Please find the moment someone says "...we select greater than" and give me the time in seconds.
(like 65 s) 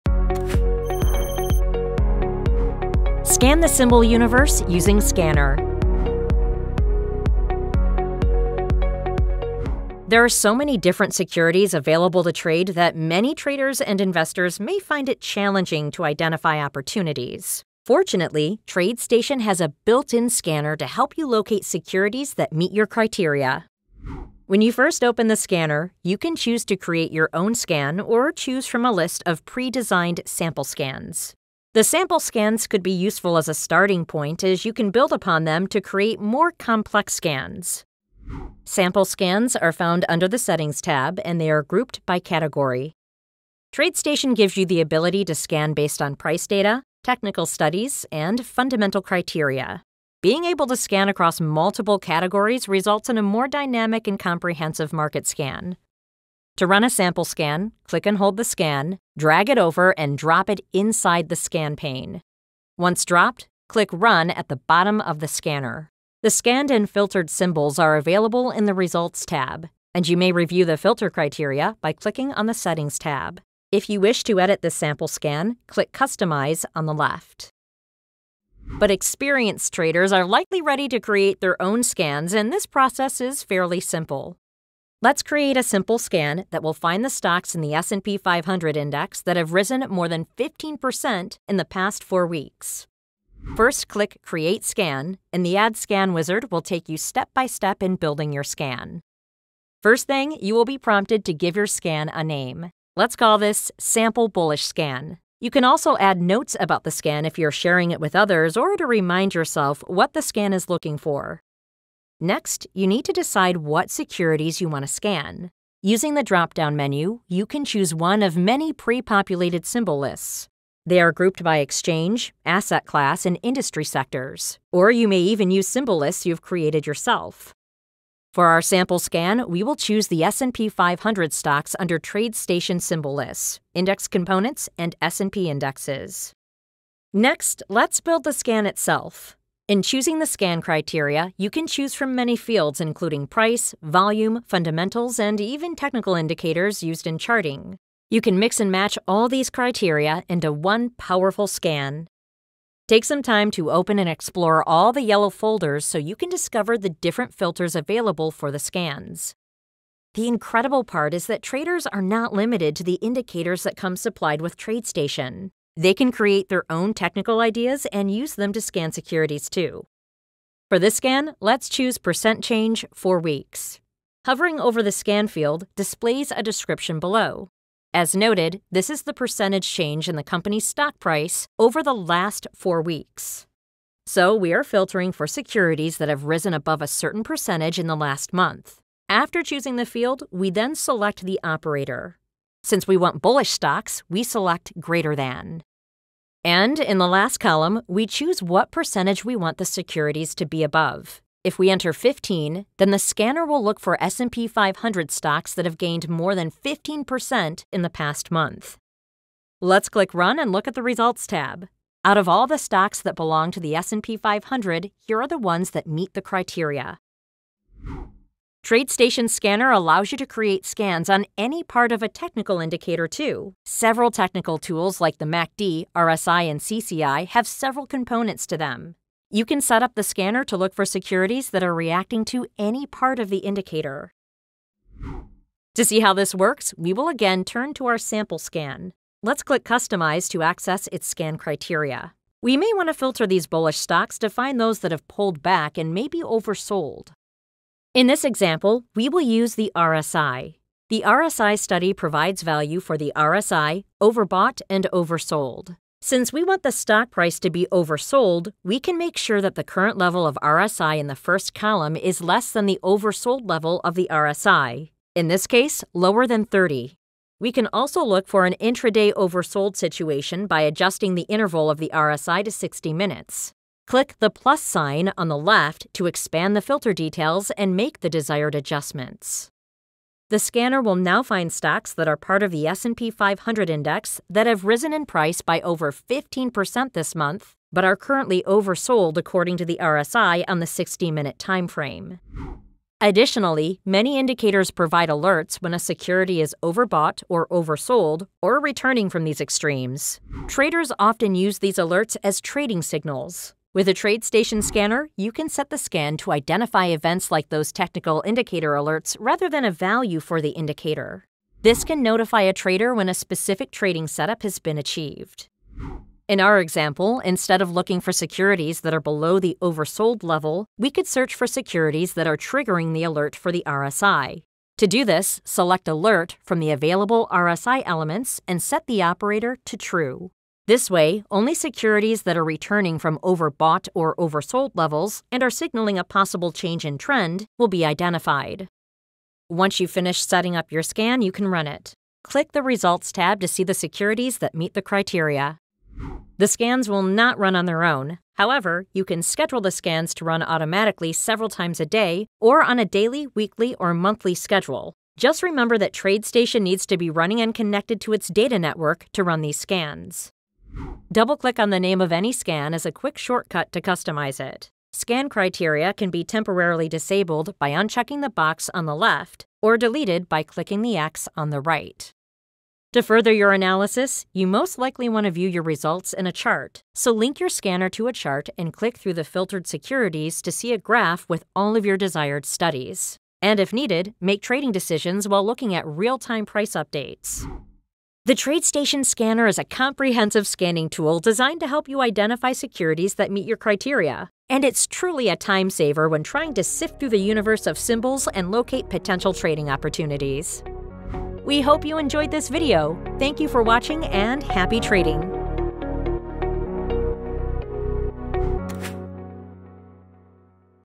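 194 s.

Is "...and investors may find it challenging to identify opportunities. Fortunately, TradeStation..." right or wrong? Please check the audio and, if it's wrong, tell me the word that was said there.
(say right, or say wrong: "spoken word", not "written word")
right.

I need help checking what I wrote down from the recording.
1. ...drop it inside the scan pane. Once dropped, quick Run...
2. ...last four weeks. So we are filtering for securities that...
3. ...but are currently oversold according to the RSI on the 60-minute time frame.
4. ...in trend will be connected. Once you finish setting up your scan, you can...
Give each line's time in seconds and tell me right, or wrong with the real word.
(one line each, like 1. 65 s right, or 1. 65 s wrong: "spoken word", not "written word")
1. 60 s wrong: "click", not "quick"
2. 181 s right
3. 287 s right
4. 336 s wrong: "identified", not "connected".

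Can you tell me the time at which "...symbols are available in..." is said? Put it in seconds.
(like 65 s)
67 s.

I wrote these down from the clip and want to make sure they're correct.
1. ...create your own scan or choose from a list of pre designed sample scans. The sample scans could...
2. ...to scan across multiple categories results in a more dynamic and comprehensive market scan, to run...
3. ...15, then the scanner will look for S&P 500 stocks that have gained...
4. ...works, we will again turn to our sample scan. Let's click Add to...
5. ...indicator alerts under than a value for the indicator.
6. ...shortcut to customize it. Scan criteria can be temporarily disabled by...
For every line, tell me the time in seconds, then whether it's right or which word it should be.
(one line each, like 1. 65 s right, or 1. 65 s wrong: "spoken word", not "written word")
1. 26 s right
2. 50 s right
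3. 201 s right
4. 236 s wrong: "Customize", not "Add"
5. 308 s wrong: "rather", not "under"
6. 363 s right.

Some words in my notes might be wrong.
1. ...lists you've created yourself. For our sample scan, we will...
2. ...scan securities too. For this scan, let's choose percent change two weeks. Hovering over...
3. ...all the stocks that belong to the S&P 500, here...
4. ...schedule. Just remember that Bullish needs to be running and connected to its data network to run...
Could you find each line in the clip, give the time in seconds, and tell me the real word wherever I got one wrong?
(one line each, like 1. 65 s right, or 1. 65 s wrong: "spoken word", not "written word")
1. 125 s right
2. 168 s wrong: "four", not "two"
3. 212 s right
4. 354 s wrong: "TradeStation", not "Bullish".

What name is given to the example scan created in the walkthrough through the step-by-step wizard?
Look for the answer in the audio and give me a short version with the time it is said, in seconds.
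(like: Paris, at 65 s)
Sample Bullish Scan, at 103 s.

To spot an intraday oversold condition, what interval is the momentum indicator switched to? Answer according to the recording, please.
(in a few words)
60 minutes.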